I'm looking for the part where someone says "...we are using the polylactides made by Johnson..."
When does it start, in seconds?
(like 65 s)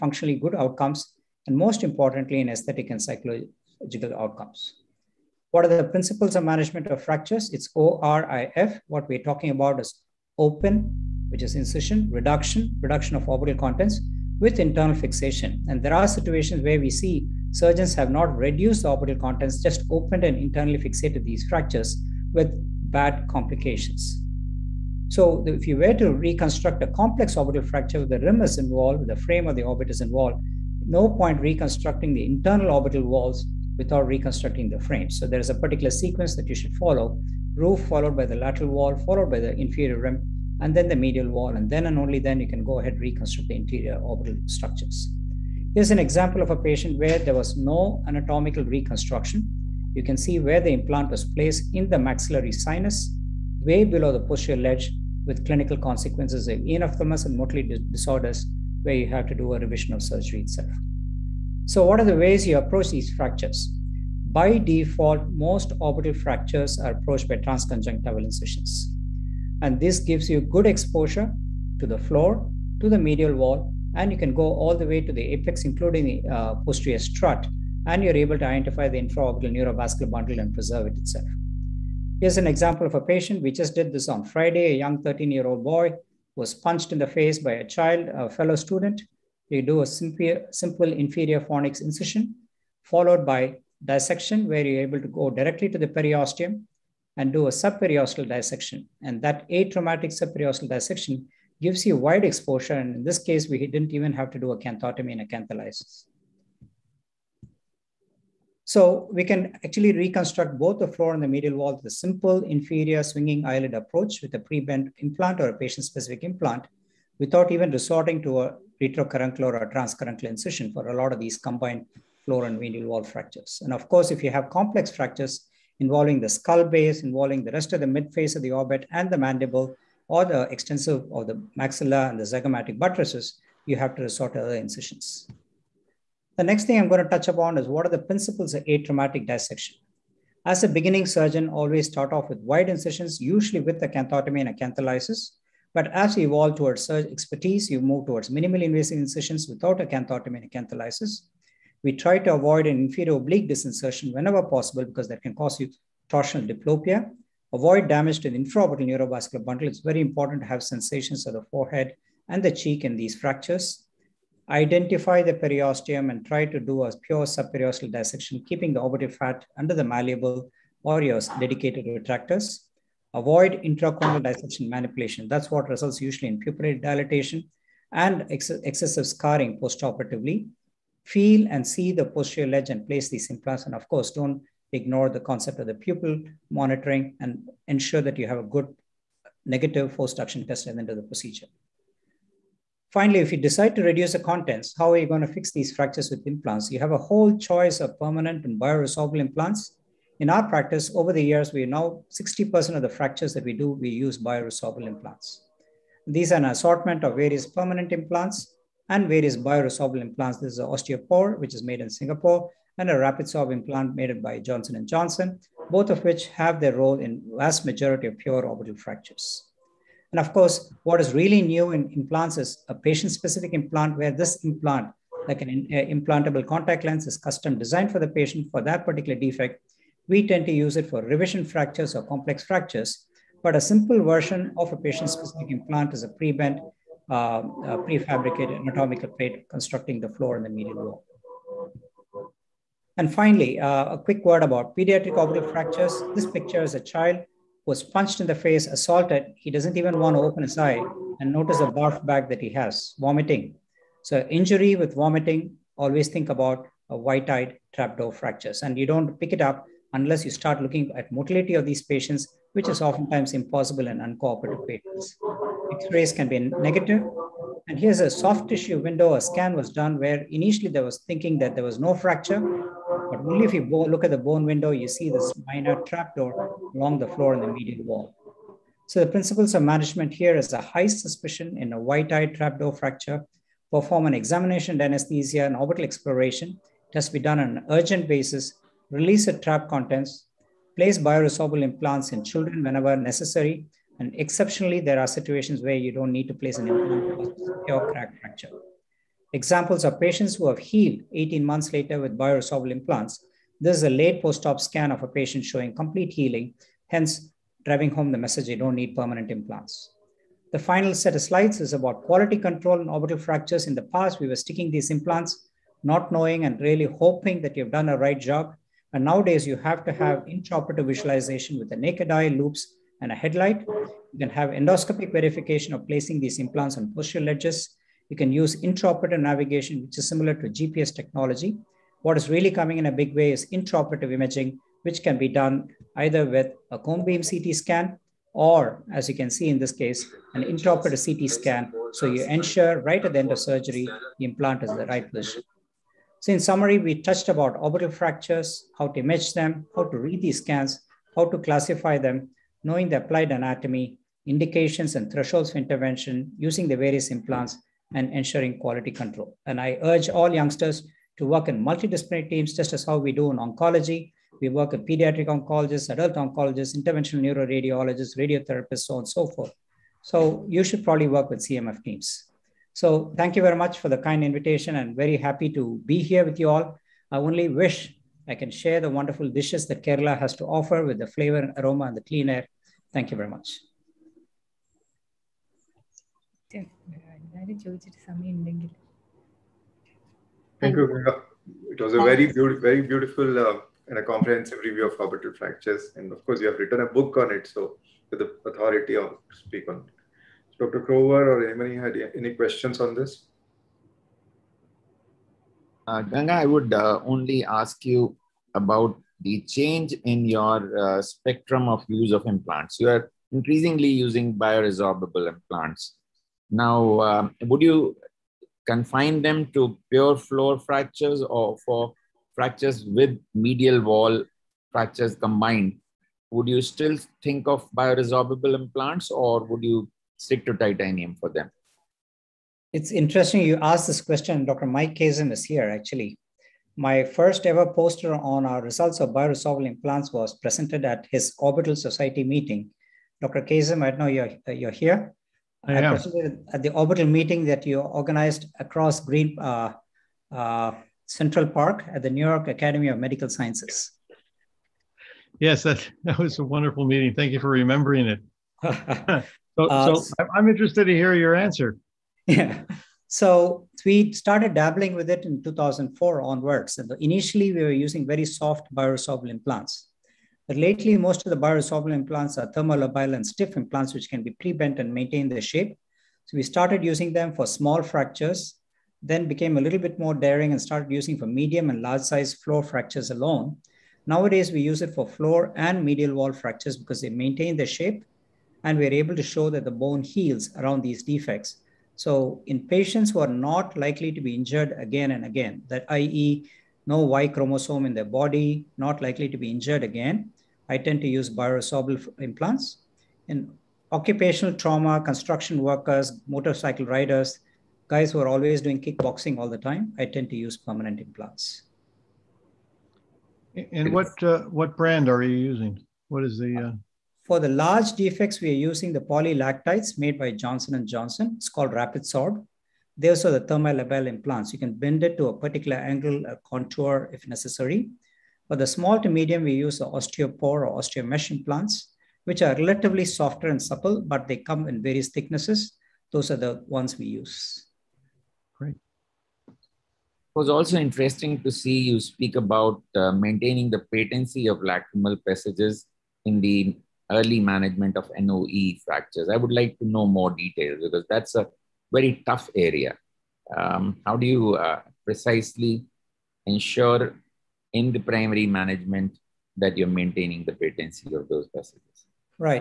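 518 s.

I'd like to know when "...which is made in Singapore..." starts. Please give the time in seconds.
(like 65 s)
211 s.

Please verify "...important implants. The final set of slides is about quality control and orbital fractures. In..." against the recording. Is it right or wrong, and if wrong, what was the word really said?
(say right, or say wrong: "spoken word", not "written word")
wrong: "permanent", not "important".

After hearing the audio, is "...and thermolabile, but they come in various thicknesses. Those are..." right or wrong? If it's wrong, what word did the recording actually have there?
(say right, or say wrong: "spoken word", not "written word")
wrong: "supple", not "thermolabile".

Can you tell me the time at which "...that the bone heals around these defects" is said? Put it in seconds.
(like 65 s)
489 s.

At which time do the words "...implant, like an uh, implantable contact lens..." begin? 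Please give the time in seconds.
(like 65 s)
224 s.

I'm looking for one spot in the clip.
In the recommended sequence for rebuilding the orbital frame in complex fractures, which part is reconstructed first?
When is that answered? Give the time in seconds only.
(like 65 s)
37 s.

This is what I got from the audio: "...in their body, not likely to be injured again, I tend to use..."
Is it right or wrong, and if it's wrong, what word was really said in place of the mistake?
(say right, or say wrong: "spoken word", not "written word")
right.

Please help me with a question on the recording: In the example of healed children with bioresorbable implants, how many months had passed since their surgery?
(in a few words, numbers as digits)
18.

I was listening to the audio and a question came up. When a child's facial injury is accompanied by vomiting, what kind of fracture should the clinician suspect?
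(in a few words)
White-eyed trapdoor fracture.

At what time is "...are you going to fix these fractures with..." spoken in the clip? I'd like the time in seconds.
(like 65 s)
194 s.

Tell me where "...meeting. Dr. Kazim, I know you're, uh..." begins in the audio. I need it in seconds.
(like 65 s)
442 s.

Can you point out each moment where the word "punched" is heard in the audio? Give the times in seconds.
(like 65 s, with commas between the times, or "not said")
86 s, 247 s.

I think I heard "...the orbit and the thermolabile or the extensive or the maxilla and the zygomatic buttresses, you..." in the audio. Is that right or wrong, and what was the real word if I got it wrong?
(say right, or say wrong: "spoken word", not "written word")
wrong: "mandible", not "thermolabile".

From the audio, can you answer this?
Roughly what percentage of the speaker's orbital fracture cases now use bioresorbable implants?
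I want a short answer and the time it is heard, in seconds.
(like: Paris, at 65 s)
60%, at 202 s.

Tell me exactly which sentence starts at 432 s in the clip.
It's interesting you asked this question.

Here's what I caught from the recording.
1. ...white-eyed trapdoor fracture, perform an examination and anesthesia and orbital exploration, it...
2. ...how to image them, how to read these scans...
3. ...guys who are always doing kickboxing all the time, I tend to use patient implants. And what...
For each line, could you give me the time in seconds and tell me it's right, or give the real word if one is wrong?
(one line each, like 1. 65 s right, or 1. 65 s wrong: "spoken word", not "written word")
1. 281 s right
2. 348 s right
3. 507 s wrong: "permanent", not "patient".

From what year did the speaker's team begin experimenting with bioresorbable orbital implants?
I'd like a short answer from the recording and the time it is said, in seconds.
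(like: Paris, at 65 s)
2004, at 465 s.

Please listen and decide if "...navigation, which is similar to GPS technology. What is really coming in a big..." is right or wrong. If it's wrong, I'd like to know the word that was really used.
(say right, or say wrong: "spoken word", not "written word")
right.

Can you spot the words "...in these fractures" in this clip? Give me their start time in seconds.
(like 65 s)
162 s.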